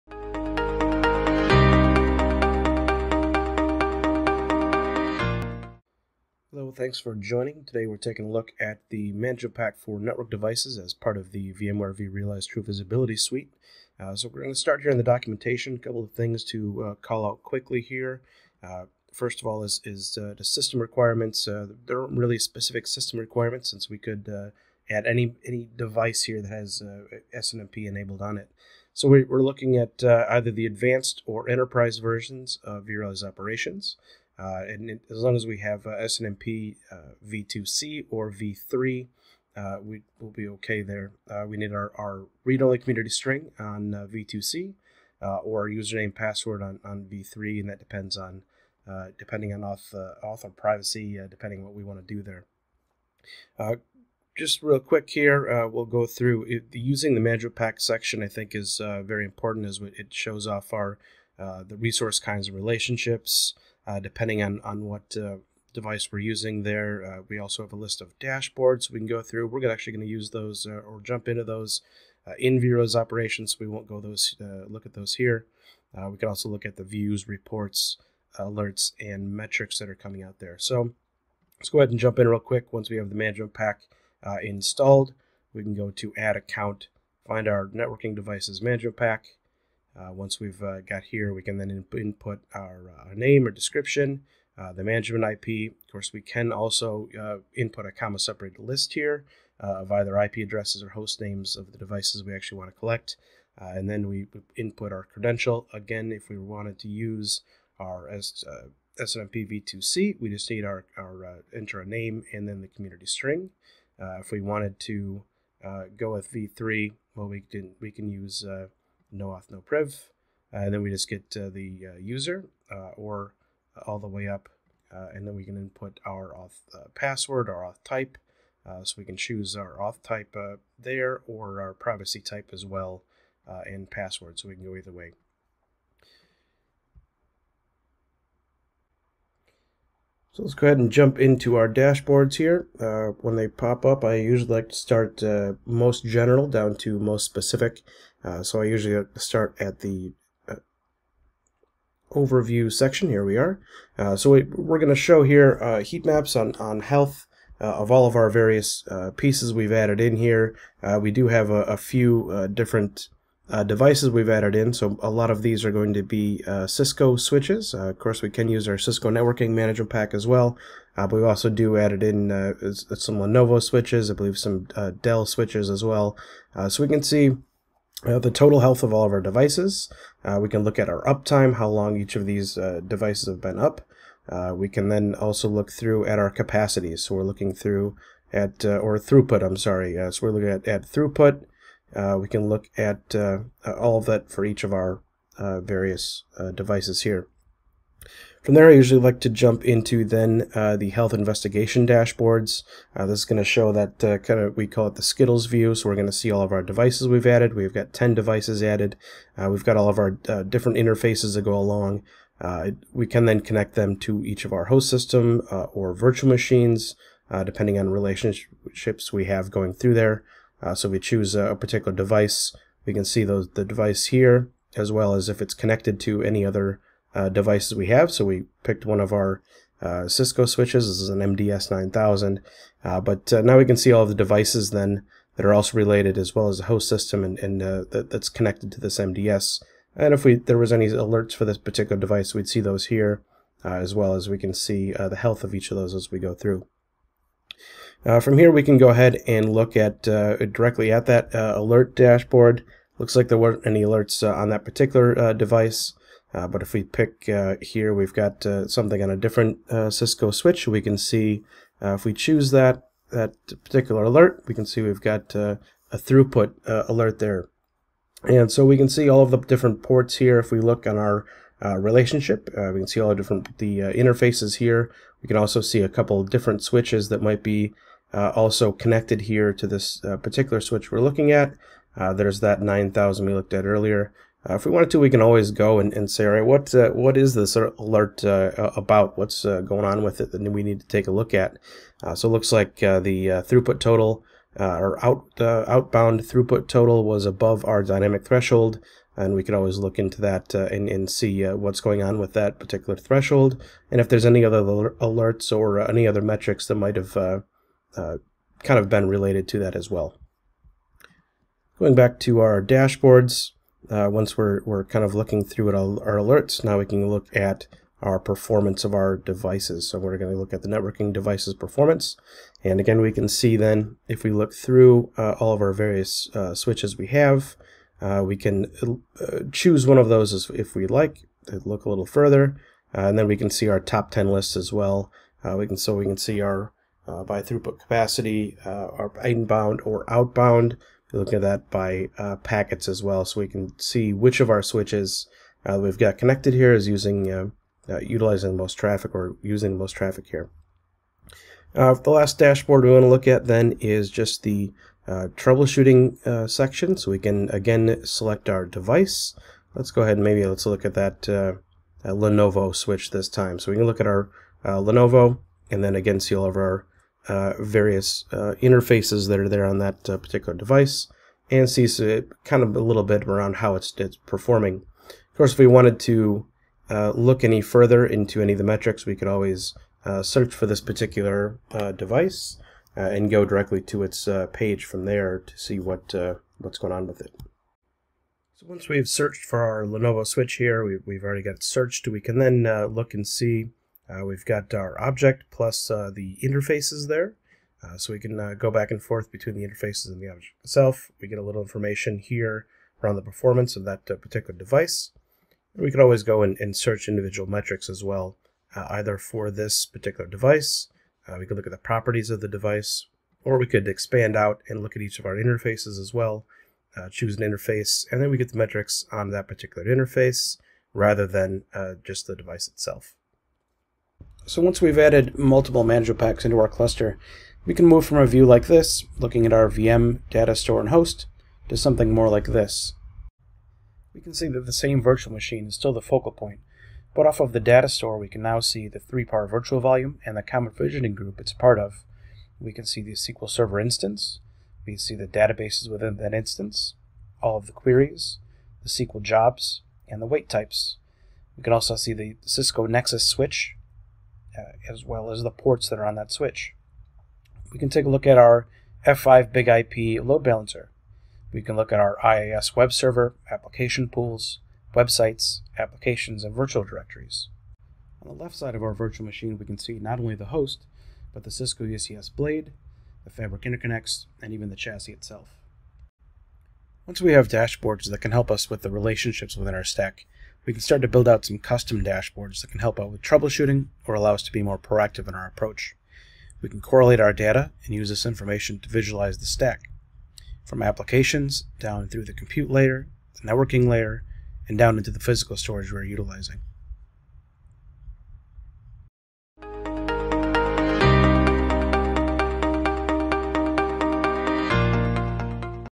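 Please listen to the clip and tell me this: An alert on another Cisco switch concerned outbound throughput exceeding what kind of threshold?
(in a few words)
dynamic threshold.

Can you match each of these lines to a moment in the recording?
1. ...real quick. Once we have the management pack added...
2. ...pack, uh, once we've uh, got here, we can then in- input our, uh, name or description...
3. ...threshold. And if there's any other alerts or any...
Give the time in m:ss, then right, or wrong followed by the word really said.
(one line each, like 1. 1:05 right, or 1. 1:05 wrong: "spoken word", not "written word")
1. 1:22 wrong: "installed", not "added"
2. 1:28 right
3. 5:02 right.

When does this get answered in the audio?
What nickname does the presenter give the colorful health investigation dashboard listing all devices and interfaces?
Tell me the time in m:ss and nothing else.
3:25.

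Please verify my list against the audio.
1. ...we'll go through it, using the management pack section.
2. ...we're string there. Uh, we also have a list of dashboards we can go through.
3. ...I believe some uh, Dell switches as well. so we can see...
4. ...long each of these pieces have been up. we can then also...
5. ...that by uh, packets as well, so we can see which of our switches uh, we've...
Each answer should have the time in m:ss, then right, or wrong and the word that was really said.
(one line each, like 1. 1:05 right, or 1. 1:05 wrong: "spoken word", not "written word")
1. 0:55 right
2. 1:06 wrong: "using", not "string"
3. 2:54 right
4. 3:01 wrong: "devices", not "pieces"
5. 5:41 right.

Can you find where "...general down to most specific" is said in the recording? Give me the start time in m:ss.
2:26.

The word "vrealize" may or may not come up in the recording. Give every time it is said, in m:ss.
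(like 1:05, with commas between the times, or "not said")
0:11, 0:32, 1:12.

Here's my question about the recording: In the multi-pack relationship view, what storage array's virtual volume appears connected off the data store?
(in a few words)
3PAR.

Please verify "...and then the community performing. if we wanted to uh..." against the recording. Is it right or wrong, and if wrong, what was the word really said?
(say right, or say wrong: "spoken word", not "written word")
wrong: "string", not "performing".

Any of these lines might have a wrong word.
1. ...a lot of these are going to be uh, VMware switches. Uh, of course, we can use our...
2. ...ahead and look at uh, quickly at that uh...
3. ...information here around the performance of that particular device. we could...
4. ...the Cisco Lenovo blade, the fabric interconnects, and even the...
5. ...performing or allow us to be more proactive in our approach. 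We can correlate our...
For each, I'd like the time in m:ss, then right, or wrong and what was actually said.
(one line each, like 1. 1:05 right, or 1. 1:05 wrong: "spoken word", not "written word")
1. 2:45 wrong: "Cisco", not "VMware"
2. 4:08 wrong: "directly", not "quickly"
3. 6:41 right
4. 7:51 wrong: "UCS", not "Lenovo"
5. 8:03 wrong: "troubleshooting", not "performing".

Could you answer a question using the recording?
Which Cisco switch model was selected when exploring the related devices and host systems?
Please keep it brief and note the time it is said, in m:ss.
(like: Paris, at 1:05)
MDS 9000, at 3:51.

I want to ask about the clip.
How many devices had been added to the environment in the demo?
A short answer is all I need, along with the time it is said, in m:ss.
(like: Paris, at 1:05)
10, at 3:27.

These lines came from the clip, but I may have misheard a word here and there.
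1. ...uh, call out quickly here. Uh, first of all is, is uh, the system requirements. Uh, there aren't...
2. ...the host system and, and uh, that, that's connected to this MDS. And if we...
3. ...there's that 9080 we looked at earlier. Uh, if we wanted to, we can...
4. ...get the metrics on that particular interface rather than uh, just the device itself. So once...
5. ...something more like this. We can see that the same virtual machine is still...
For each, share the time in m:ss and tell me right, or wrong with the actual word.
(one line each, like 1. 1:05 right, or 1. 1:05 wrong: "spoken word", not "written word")
1. 0:16 right
2. 3:56 right
3. 4:42 wrong: "9000", not "9080"
4. 6:58 right
5. 7:11 right.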